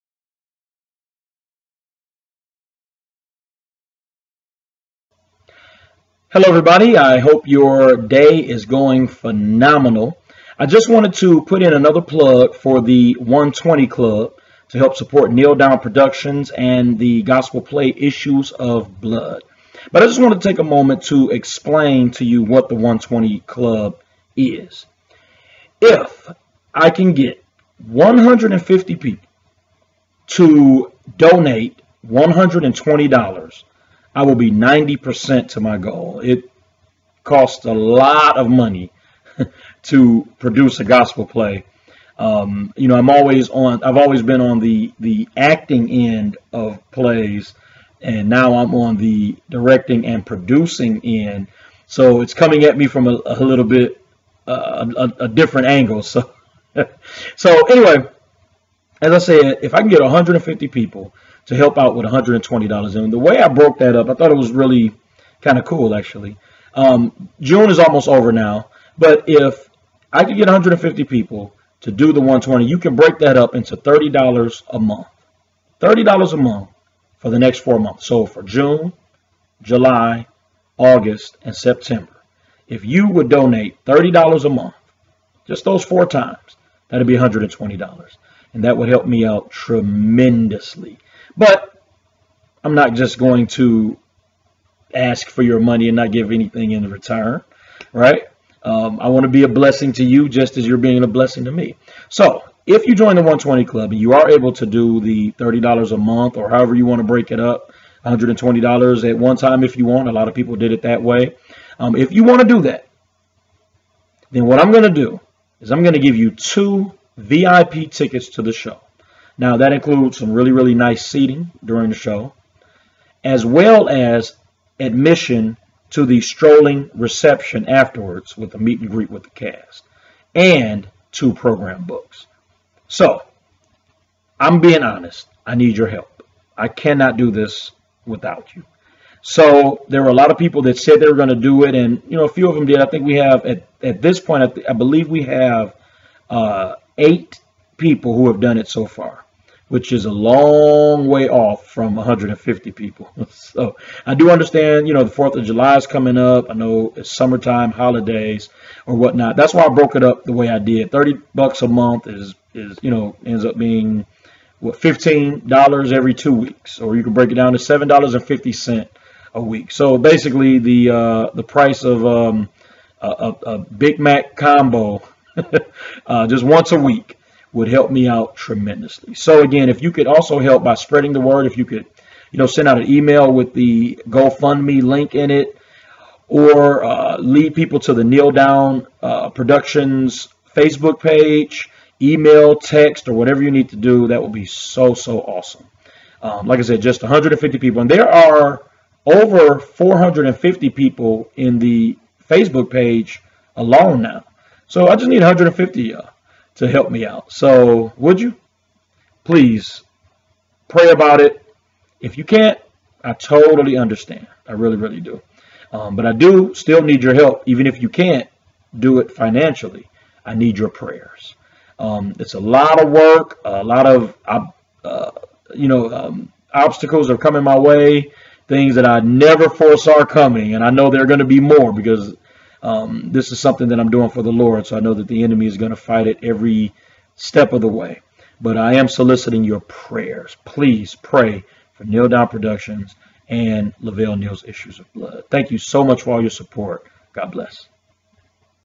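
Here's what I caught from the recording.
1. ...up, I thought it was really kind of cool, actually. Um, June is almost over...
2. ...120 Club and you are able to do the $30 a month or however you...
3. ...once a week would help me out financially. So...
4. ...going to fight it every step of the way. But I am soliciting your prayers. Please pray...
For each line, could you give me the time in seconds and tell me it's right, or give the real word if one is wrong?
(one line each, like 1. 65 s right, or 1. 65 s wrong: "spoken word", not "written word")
1. 63 s right
2. 103 s right
3. 176 s wrong: "tremendously", not "financially"
4. 235 s right.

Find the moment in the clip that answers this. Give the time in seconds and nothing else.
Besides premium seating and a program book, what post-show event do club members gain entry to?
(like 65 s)
126 s.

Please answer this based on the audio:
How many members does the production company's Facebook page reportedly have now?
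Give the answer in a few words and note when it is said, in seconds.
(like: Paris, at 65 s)
over 450, at 199 s.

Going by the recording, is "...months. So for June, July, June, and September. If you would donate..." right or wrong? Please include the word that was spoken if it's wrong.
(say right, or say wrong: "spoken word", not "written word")
wrong: "August", not "June".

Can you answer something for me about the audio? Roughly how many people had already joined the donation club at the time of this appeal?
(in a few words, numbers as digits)
8.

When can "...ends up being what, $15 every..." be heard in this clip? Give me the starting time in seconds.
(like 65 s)
163 s.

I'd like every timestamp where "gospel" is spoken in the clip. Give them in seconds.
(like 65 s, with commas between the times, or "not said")
17 s, 40 s.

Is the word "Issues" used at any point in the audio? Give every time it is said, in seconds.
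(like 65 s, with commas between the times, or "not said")
17 s, 244 s.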